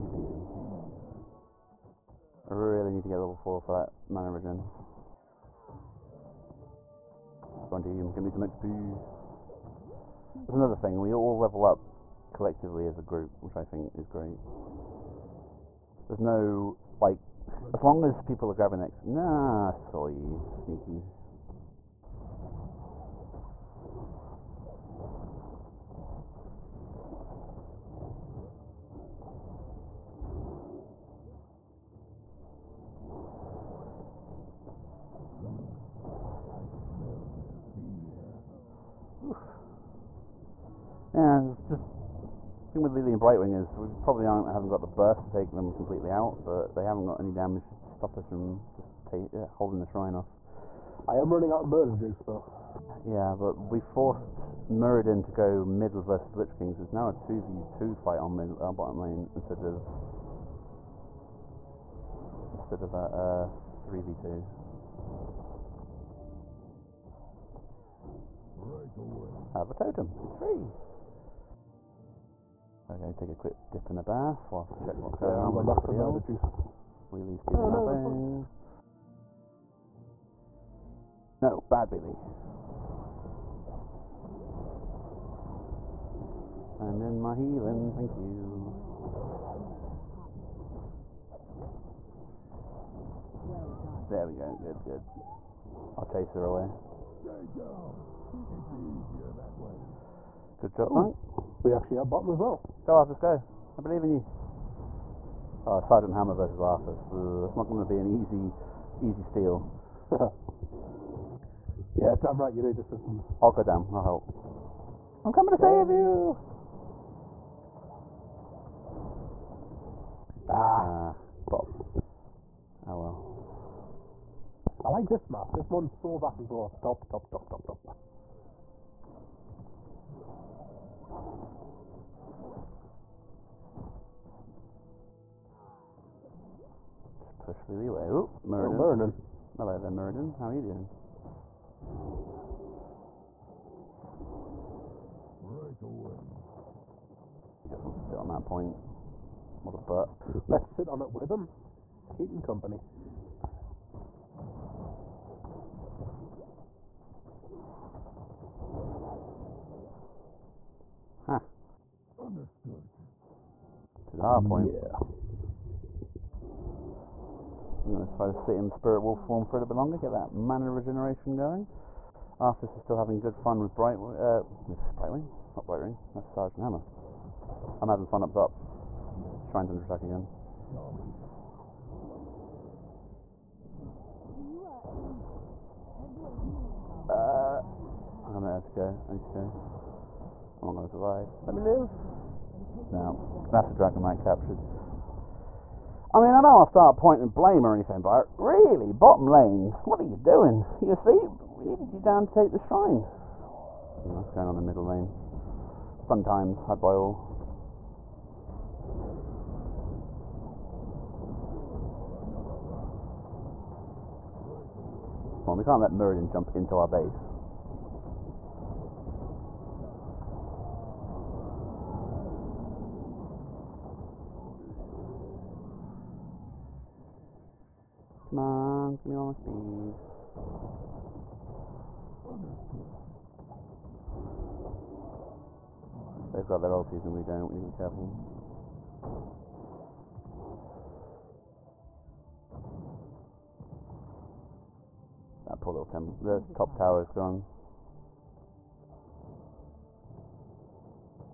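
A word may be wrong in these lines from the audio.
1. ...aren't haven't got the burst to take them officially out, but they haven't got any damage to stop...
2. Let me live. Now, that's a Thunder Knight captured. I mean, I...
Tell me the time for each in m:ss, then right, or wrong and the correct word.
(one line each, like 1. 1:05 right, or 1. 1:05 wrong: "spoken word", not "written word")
1. 0:44 wrong: "completely", not "officially"
2. 3:11 wrong: "Dragon", not "Thunder".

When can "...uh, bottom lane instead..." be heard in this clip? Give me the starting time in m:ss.
0:58.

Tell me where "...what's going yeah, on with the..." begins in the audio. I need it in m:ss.
1:15.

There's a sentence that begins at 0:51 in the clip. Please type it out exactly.
I am running out of murder juice though.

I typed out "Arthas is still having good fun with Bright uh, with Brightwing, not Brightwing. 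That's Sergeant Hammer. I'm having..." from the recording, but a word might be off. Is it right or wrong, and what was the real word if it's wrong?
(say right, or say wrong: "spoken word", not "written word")
right.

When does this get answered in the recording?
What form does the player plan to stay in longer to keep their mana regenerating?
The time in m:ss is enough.
2:48.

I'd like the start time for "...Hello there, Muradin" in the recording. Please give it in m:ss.
2:19.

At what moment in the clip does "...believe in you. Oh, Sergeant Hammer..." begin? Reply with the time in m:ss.
1:43.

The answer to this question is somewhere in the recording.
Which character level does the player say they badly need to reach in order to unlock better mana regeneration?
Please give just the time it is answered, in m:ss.
0:03.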